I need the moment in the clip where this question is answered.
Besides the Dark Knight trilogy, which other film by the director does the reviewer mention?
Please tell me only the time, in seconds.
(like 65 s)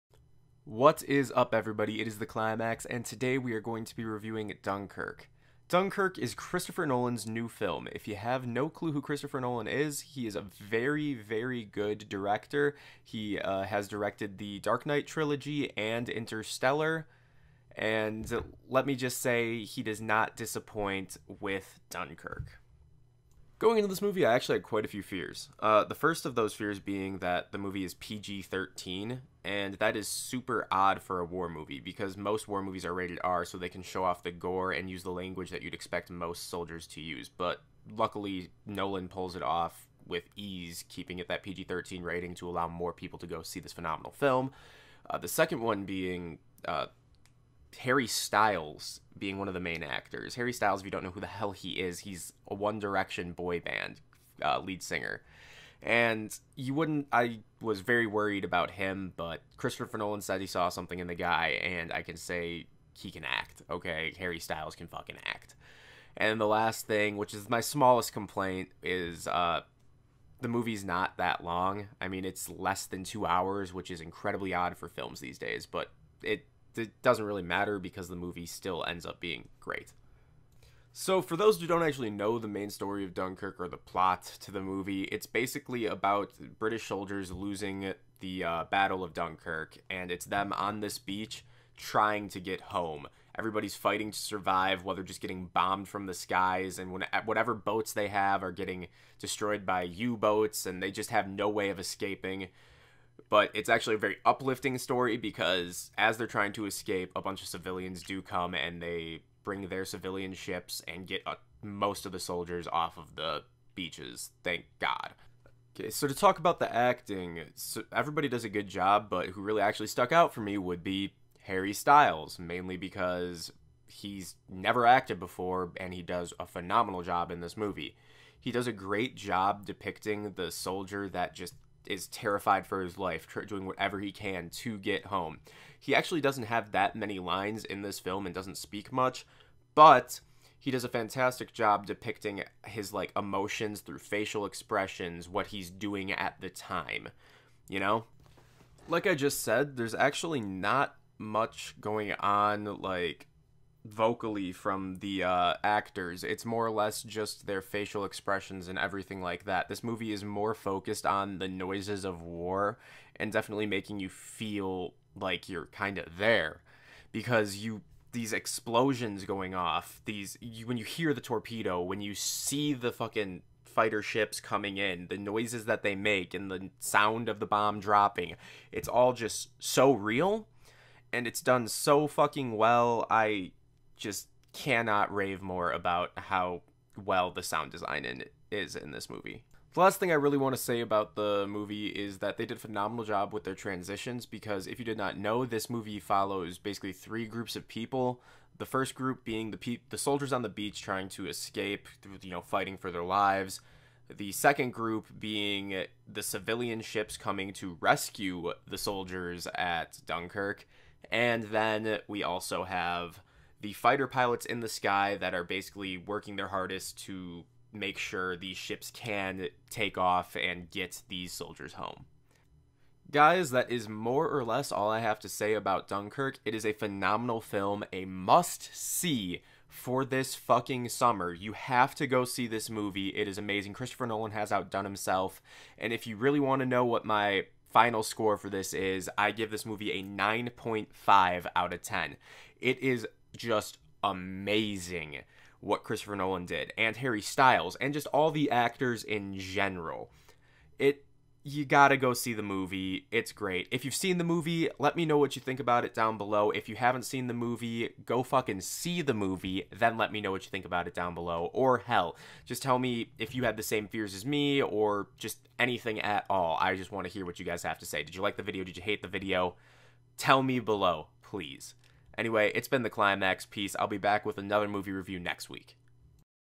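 16 s.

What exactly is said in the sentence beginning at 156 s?
It's more or less just their facial expressions and everything like that.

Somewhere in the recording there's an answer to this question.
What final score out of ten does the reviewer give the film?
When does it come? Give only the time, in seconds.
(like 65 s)
240 s.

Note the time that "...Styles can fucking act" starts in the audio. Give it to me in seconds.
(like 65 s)
64 s.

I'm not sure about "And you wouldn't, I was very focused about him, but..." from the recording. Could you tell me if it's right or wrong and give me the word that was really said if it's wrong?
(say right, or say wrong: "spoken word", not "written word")
wrong: "worried", not "focused".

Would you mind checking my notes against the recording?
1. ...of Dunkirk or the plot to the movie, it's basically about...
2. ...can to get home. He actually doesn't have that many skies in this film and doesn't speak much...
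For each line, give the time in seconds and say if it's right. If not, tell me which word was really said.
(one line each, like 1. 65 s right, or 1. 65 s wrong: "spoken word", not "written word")
1. 83 s right
2. 134 s wrong: "lines", not "skies".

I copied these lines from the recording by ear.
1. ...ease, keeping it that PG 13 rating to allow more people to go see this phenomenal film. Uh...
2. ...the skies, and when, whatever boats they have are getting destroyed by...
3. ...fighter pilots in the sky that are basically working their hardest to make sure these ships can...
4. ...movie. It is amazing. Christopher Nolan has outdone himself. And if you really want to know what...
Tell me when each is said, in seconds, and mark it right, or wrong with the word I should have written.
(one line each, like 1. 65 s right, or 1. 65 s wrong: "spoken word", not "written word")
1. 40 s right
2. 96 s right
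3. 213 s right
4. 232 s right.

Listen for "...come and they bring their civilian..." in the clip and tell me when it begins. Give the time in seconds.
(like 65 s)
108 s.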